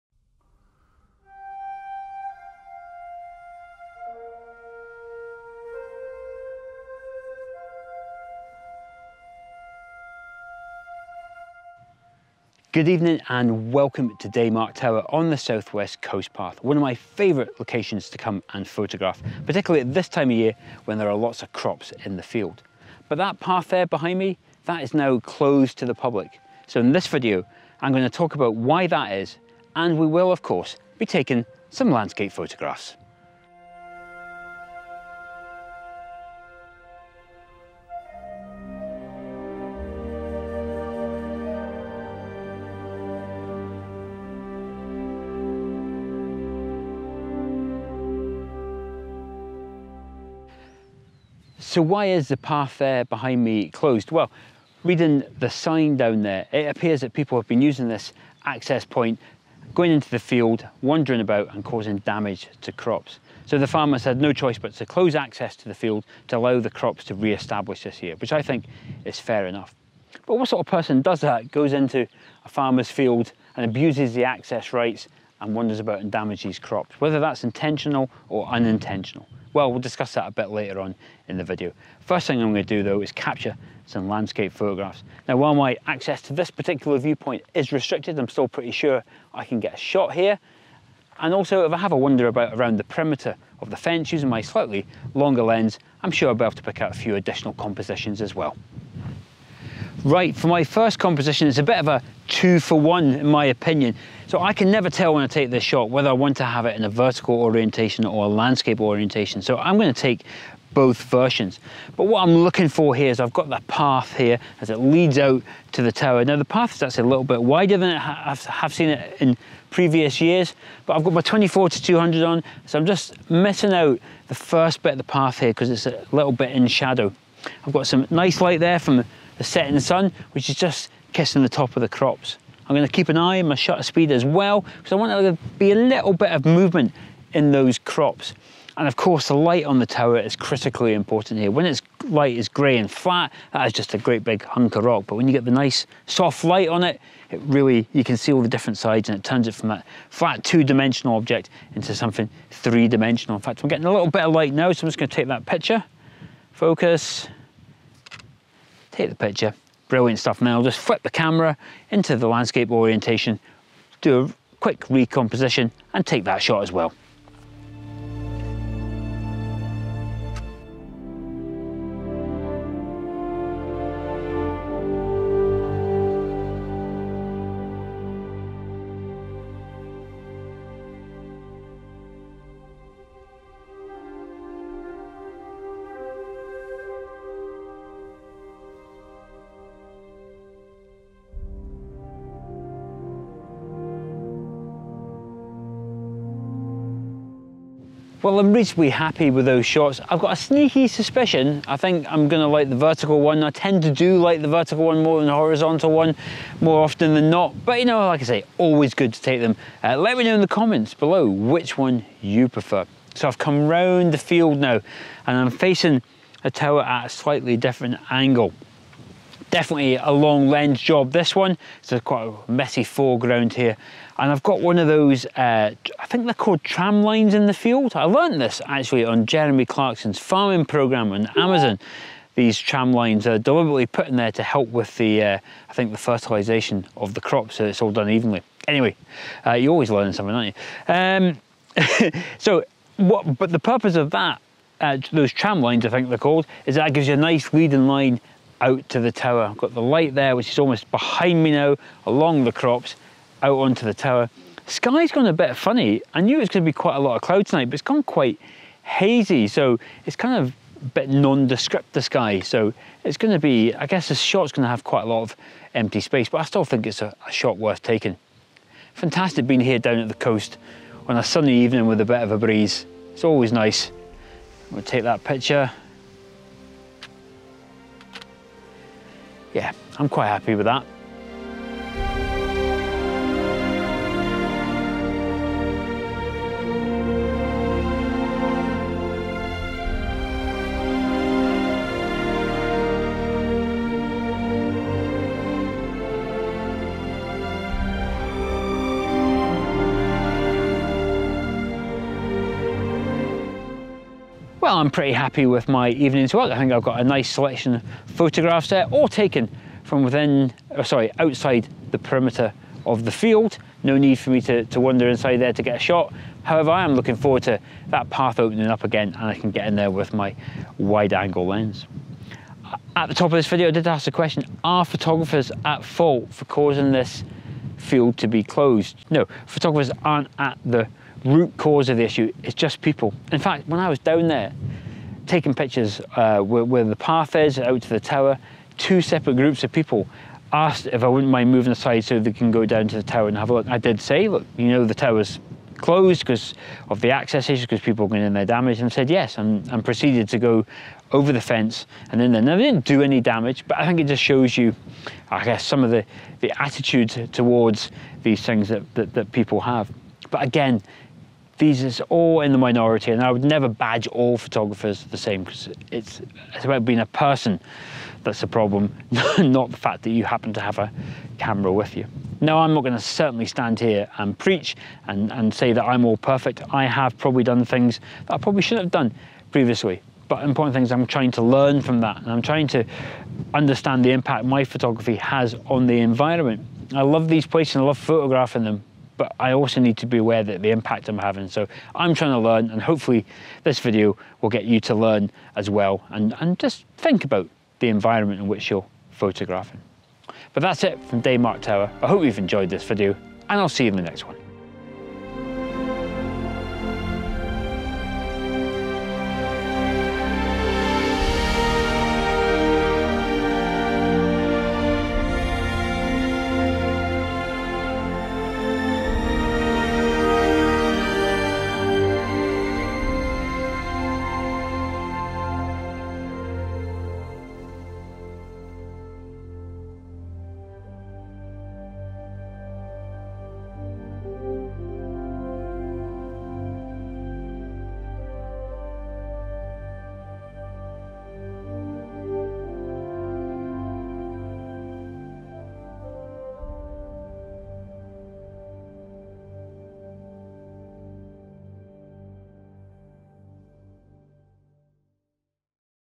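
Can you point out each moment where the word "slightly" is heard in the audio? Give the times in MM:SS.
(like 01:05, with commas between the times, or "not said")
01:34, 03:37.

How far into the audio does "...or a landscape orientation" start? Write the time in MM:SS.
01:48.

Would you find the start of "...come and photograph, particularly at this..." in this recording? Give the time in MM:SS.
00:18.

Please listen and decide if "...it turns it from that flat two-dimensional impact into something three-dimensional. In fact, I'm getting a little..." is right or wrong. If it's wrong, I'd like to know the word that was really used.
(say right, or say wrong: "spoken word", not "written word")
wrong: "object", not "impact".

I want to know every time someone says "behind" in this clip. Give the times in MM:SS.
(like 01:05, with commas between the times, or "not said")
00:23, 00:53, 04:10.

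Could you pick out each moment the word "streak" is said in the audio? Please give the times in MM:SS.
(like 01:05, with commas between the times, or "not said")
not said.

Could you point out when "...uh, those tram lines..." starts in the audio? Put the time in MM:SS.
04:04.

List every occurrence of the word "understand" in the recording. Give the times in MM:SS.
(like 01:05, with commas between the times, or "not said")
06:23.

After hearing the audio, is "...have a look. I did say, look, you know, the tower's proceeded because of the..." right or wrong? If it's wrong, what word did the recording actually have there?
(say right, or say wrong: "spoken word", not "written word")
wrong: "closed", not "proceeded".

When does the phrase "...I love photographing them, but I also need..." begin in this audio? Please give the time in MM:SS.
06:27.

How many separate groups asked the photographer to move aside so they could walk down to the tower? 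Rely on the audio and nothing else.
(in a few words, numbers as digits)
2.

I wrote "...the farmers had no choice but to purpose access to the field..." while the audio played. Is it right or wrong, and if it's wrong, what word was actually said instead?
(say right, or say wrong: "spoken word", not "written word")
wrong: "close", not "purpose".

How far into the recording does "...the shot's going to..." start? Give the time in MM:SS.
04:24.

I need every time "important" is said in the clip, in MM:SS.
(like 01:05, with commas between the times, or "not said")
02:20, 06:20.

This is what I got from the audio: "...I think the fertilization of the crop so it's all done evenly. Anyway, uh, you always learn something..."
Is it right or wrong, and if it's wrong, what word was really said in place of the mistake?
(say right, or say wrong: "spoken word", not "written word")
right.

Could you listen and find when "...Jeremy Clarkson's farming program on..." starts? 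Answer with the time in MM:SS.
03:49.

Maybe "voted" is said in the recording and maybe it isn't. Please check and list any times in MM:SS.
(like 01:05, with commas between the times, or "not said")
not said.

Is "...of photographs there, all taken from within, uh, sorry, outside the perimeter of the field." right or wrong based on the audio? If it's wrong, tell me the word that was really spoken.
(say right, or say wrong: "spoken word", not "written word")
right.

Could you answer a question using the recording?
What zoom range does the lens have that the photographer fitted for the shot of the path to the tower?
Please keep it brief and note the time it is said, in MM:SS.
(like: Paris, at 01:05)
24 to 200, at 02:01.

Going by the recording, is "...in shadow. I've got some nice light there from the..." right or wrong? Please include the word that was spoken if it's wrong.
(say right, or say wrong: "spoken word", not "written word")
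right.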